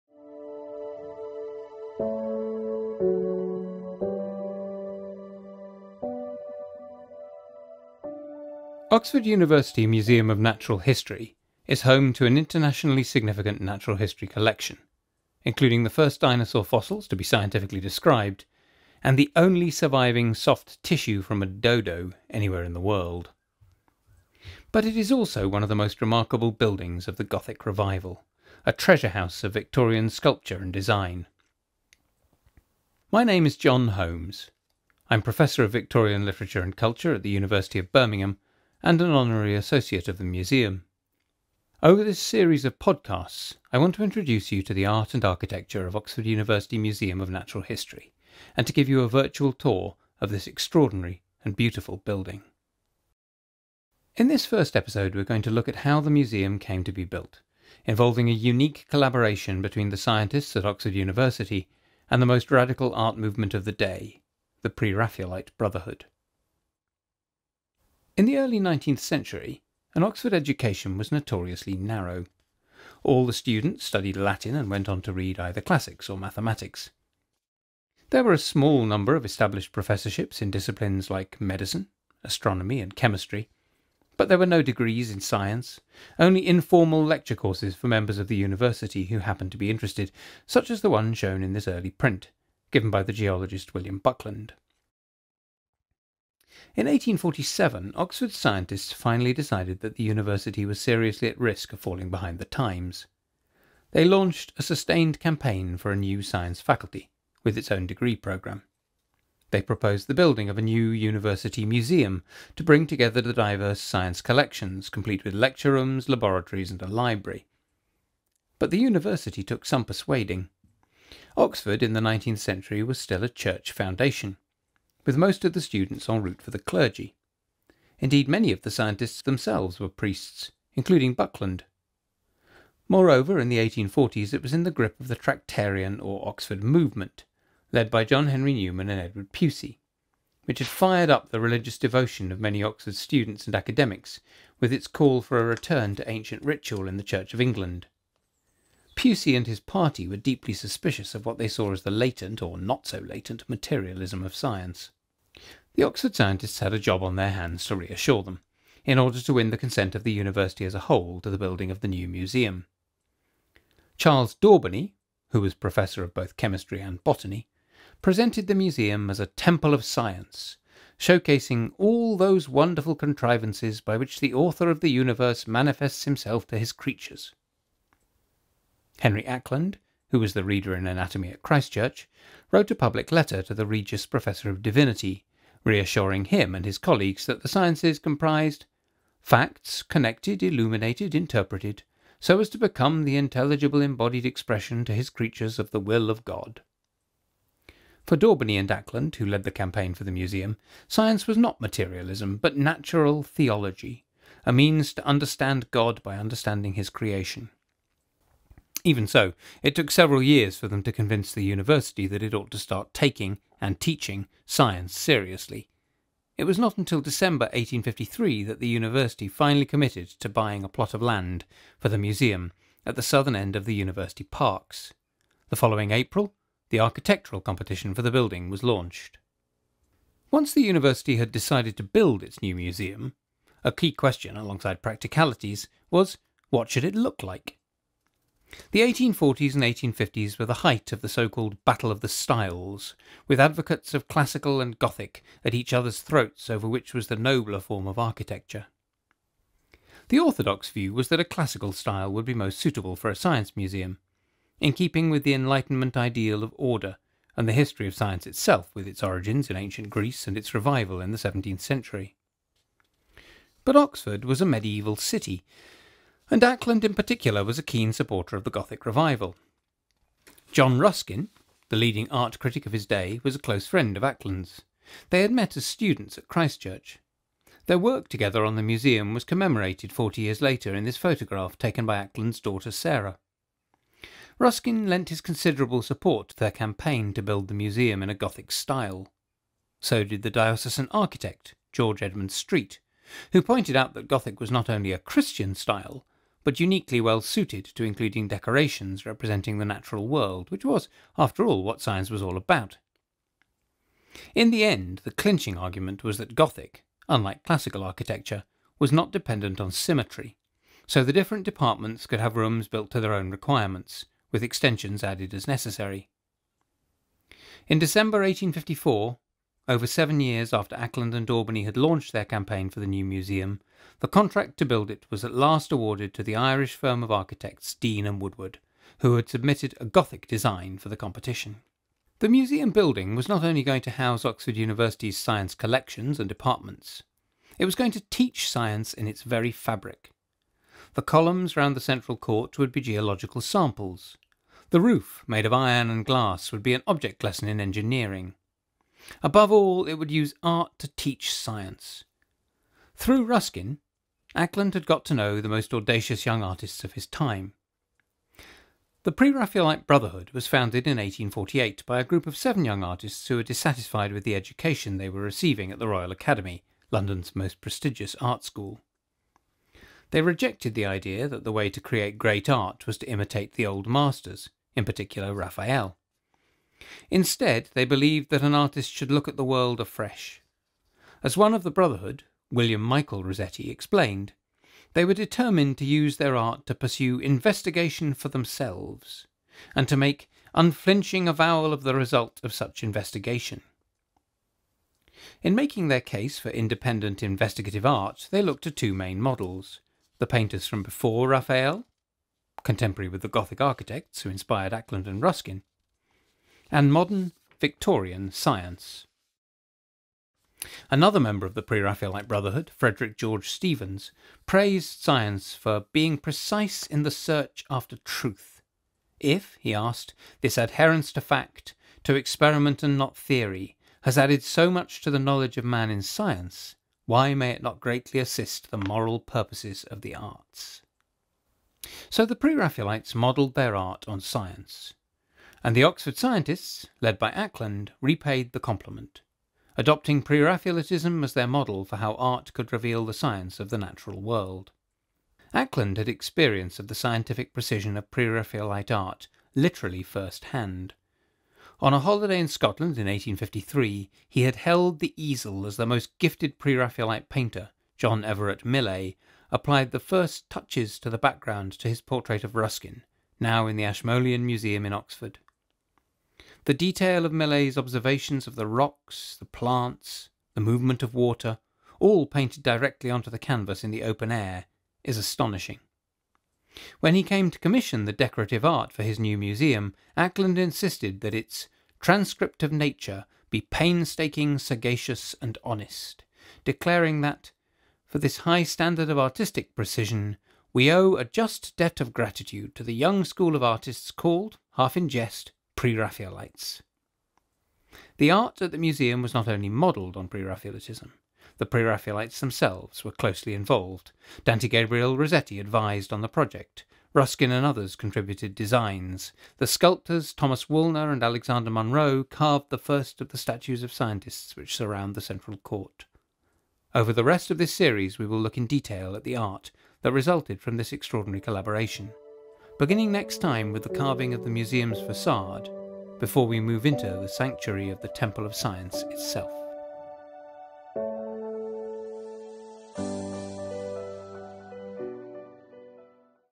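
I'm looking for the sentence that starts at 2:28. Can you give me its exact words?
Pusey and his party were deeply suspicious of what they saw as the latent, or not so latent, materialism of science.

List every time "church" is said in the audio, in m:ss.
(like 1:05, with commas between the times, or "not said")
2:03, 2:27, 3:01, 4:36.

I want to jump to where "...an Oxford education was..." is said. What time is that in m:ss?
1:09.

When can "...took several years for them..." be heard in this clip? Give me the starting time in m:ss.
3:29.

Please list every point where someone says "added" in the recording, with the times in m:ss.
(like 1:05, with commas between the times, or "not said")
5:15, 7:04.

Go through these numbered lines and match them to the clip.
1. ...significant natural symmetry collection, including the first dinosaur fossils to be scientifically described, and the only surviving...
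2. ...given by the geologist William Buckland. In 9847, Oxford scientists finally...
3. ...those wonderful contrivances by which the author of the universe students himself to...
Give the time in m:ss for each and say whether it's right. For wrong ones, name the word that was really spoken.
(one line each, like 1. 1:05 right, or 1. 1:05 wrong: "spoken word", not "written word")
1. 0:13 wrong: "history", not "symmetry"
2. 1:32 wrong: "1847", not "9847"
3. 2:52 wrong: "manifests", not "students".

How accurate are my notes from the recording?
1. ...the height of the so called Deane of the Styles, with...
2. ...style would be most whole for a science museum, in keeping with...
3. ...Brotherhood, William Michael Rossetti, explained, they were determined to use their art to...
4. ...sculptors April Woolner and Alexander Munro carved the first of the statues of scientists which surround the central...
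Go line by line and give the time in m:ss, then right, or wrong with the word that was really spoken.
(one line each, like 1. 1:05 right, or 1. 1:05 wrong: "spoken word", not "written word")
1. 4:00 wrong: "Battle", not "Deane"
2. 4:11 wrong: "suitable", not "whole"
3. 6:21 right
4. 8:29 wrong: "Thomas", not "April".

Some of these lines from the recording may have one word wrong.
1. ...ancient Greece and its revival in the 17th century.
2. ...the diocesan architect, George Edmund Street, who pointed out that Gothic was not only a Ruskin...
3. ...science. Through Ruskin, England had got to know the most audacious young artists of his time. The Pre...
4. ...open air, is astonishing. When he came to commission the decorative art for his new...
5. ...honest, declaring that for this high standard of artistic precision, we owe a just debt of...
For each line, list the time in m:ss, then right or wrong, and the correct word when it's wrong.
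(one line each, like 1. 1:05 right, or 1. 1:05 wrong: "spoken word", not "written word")
1. 4:19 right
2. 4:50 wrong: "Christian", not "Ruskin"
3. 5:51 wrong: "Acland", not "England"
4. 7:54 right
5. 8:05 right.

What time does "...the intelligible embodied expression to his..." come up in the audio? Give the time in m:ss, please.
3:13.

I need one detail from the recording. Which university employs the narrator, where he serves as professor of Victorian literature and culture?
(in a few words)
University of Birmingham.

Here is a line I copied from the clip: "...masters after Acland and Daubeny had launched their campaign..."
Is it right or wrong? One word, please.
wrong.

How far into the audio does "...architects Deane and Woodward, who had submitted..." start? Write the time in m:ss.
5:27.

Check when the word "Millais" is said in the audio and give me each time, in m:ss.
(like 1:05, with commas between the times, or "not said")
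7:38, 7:47.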